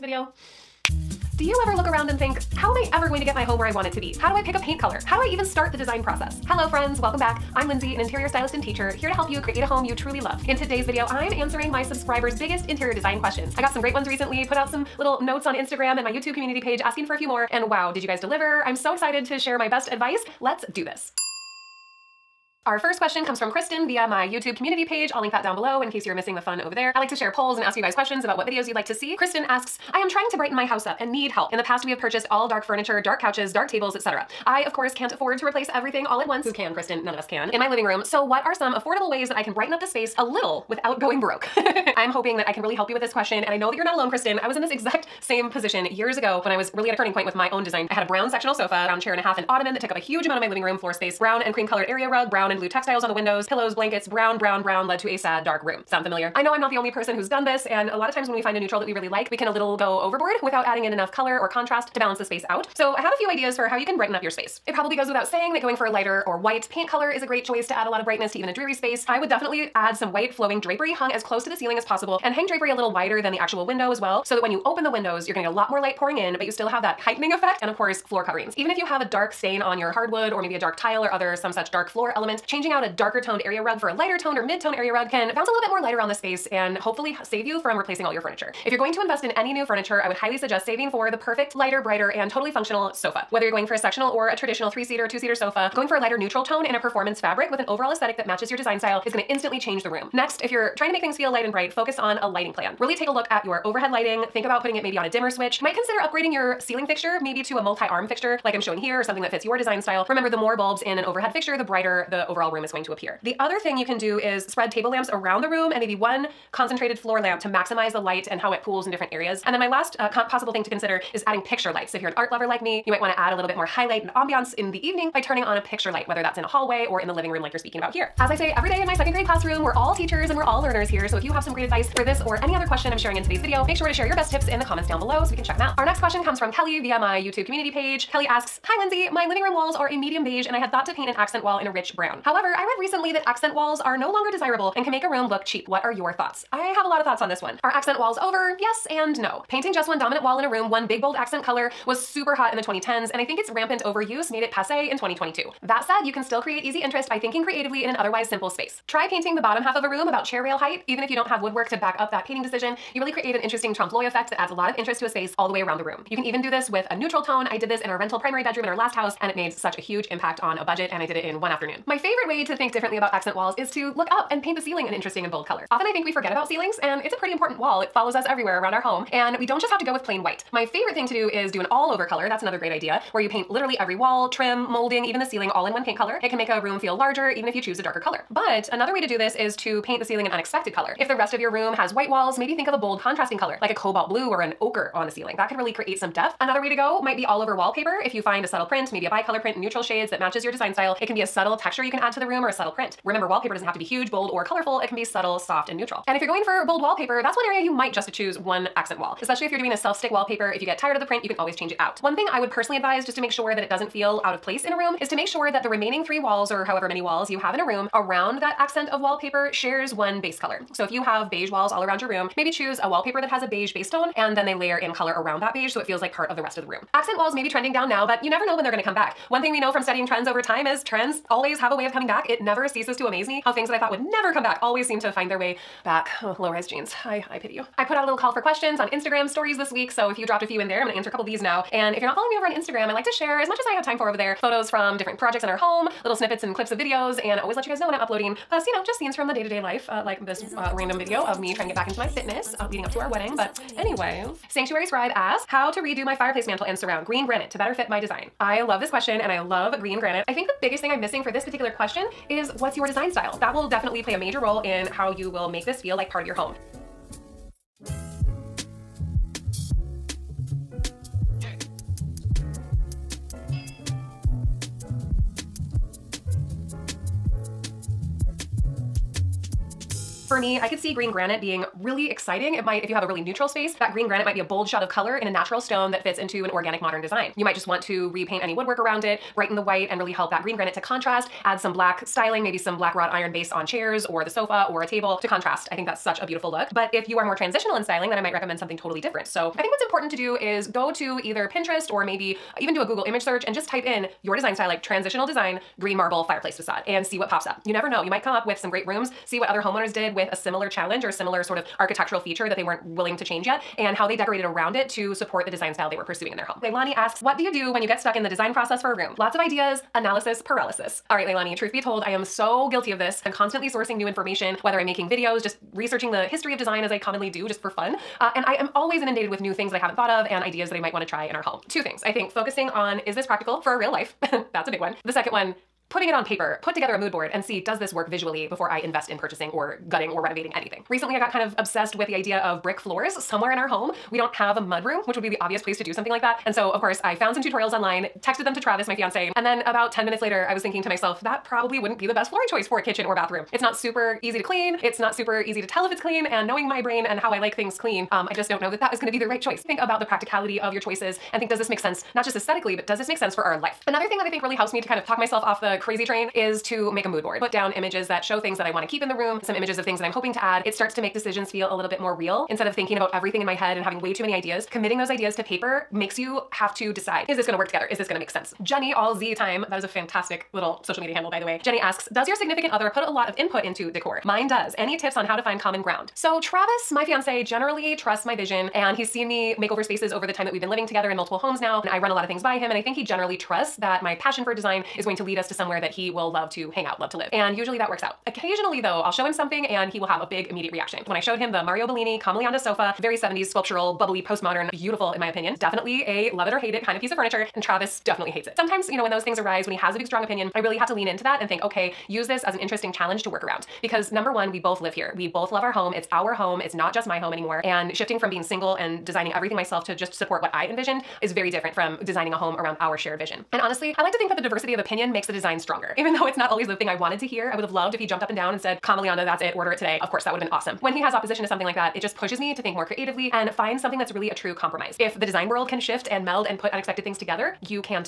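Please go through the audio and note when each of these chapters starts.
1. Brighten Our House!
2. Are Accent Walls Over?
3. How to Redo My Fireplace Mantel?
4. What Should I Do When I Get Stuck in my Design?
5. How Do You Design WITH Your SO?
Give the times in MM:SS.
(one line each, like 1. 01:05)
1. 00:22
2. 02:17
3. 04:19
4. 05:21
5. 06:23.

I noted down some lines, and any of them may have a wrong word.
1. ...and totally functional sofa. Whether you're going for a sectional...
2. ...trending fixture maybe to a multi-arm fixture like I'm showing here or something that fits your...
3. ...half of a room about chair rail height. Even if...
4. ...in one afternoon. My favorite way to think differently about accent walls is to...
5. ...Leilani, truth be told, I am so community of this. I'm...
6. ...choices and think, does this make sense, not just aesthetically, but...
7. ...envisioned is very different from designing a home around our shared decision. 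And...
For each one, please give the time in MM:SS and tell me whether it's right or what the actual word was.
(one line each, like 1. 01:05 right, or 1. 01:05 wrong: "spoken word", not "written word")
1. 01:32 right
2. 01:46 wrong: "ceiling", not "trending"
3. 02:39 right
4. 02:51 right
5. 05:21 wrong: "guilty", not "community"
6. 06:00 right
7. 07:00 wrong: "vision", not "decision".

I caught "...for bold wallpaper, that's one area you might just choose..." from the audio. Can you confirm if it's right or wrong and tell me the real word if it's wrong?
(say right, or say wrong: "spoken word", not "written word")
right.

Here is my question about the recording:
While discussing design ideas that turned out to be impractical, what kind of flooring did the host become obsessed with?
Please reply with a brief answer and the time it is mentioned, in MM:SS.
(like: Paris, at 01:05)
brick floors, at 05:42.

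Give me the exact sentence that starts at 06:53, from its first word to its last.
Because number one, we both live here.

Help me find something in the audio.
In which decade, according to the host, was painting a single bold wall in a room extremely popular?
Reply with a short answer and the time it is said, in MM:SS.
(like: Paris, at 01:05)
2010s, at 02:32.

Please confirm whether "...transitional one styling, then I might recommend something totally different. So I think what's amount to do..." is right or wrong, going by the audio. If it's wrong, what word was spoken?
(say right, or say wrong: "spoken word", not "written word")
wrong: "important", not "amount".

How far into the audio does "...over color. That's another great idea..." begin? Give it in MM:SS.
03:01.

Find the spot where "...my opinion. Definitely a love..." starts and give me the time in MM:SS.
06:45.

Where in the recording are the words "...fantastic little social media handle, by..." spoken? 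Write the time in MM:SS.
06:19.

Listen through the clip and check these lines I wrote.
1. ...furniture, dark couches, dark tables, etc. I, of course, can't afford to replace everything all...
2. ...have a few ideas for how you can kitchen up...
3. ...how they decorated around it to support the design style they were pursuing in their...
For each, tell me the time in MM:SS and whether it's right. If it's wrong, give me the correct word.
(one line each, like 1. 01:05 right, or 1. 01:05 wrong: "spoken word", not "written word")
1. 00:32 right
2. 01:02 wrong: "brighten", not "kitchen"
3. 05:13 right.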